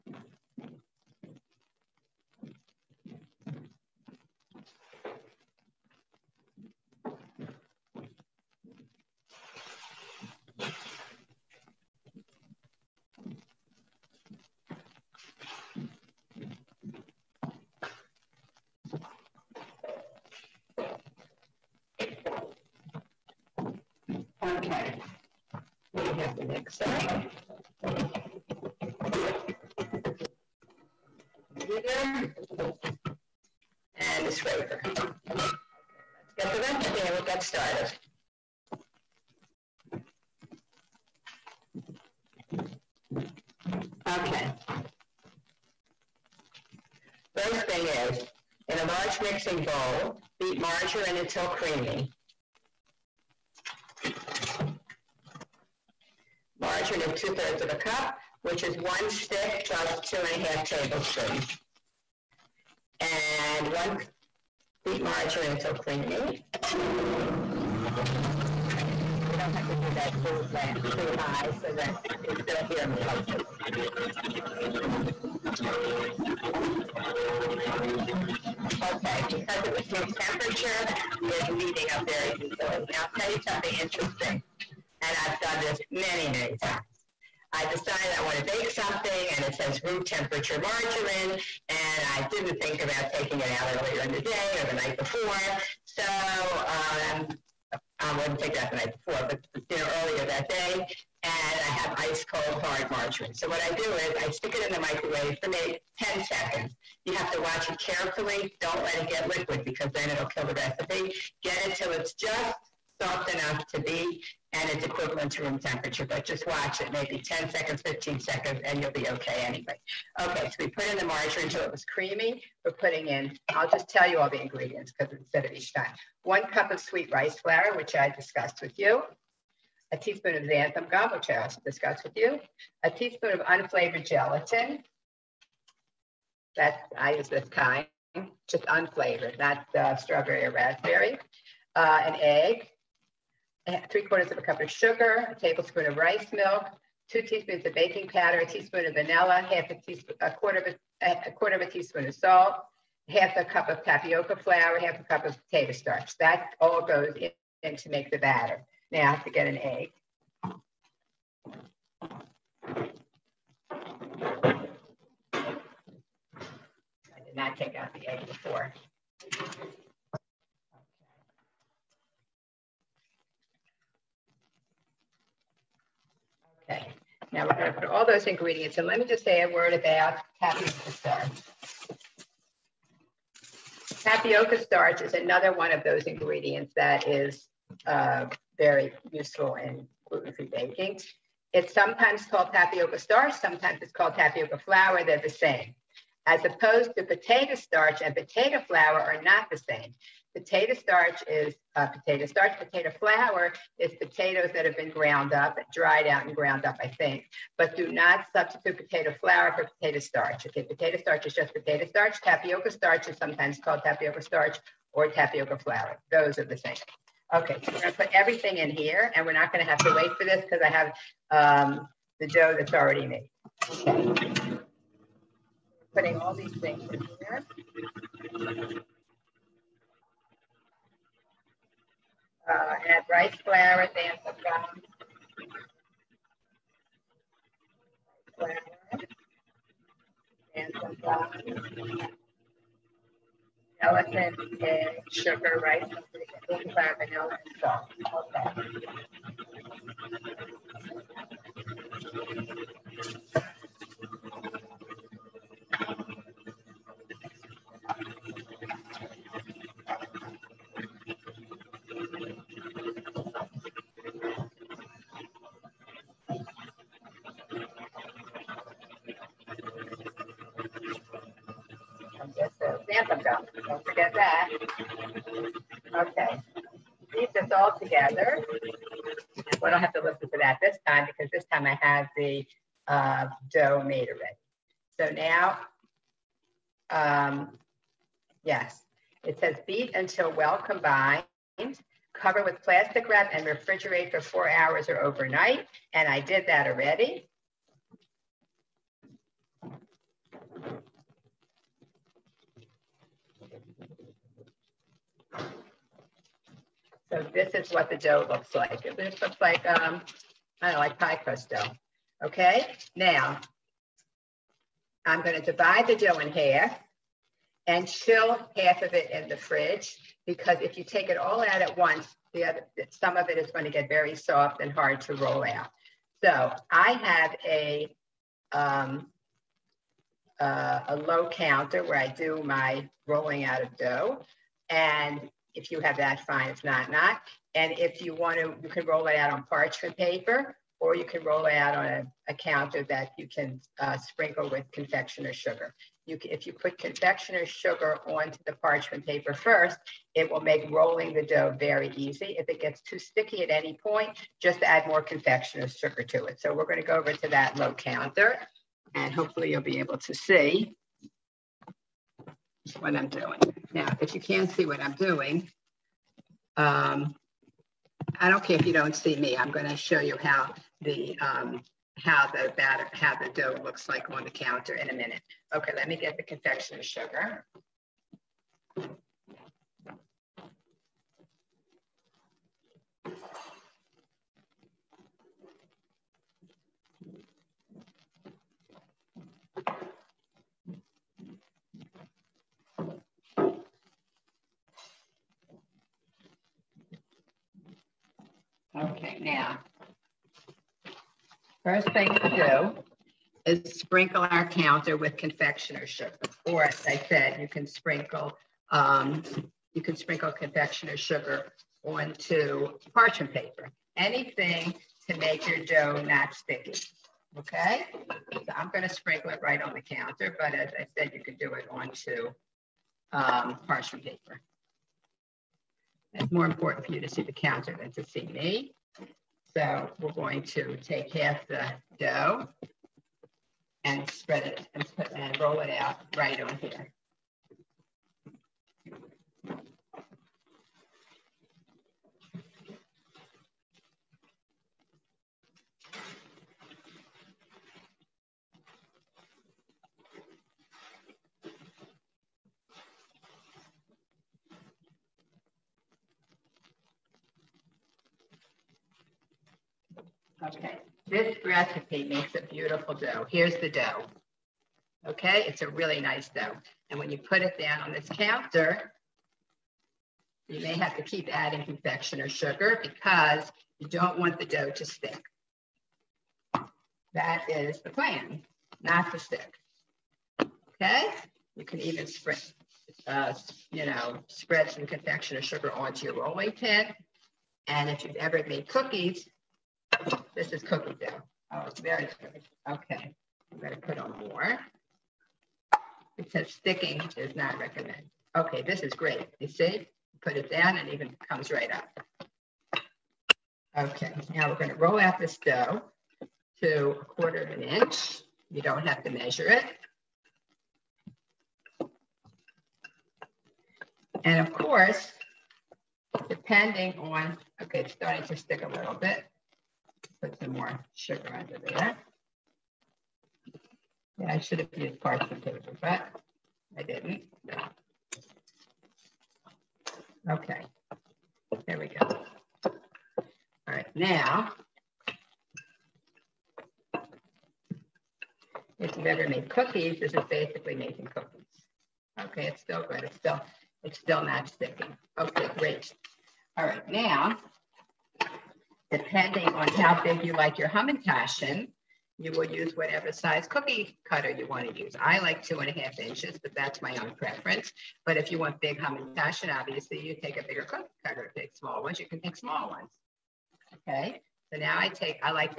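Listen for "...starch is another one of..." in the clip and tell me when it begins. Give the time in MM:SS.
03:04.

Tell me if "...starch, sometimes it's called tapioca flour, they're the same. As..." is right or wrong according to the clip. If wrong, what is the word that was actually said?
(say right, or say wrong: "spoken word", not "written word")
right.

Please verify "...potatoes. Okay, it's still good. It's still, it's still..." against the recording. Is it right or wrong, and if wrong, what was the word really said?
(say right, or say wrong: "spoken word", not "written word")
wrong: "cookies", not "potatoes".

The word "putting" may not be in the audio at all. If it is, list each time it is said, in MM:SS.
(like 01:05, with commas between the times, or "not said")
02:02, 03:45.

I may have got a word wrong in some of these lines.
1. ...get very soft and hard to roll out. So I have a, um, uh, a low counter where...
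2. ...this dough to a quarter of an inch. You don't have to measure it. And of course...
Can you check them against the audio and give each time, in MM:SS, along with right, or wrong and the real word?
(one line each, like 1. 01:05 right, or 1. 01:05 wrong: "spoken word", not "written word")
1. 05:23 right
2. 08:25 right.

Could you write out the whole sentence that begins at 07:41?
This recipe makes a beautiful dough.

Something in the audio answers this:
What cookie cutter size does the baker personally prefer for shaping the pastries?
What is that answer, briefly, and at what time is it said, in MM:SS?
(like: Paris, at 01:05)
2.5 inches, at 09:15.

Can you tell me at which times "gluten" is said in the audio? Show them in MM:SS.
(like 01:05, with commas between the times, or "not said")
03:10.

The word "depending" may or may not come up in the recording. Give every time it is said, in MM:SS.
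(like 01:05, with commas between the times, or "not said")
08:36, 09:08.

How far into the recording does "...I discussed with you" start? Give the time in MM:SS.
02:07.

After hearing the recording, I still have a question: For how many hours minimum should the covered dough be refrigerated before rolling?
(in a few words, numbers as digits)
4 hours.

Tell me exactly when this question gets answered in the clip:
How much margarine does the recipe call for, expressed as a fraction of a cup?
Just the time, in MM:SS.
00:57.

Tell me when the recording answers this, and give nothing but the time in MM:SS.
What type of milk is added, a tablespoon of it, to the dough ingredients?
02:25.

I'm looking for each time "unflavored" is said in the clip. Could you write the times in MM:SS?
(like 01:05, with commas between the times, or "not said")
02:13, 02:18.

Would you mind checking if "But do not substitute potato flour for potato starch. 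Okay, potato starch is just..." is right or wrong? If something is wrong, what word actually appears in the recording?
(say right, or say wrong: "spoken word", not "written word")
right.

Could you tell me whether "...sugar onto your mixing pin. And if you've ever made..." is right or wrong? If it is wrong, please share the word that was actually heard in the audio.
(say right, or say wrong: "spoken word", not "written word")
wrong: "rolling", not "mixing".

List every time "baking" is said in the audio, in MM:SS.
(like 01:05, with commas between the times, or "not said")
02:27, 03:10, 04:06.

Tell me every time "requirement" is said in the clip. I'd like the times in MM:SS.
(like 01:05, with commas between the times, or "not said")
not said.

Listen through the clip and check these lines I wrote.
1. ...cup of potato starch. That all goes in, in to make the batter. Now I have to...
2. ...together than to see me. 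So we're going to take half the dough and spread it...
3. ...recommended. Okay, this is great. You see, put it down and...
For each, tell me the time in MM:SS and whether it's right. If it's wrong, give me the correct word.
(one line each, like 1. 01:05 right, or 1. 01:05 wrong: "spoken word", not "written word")
1. 02:35 right
2. 07:07 wrong: "counter", not "together"
3. 08:17 right.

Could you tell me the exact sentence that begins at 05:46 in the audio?
You can, if you put confectioner sugar onto the parchment paper first, it will make rolling the dough very easy.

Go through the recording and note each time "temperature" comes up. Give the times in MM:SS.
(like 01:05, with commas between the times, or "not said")
01:20, 01:30, 01:55.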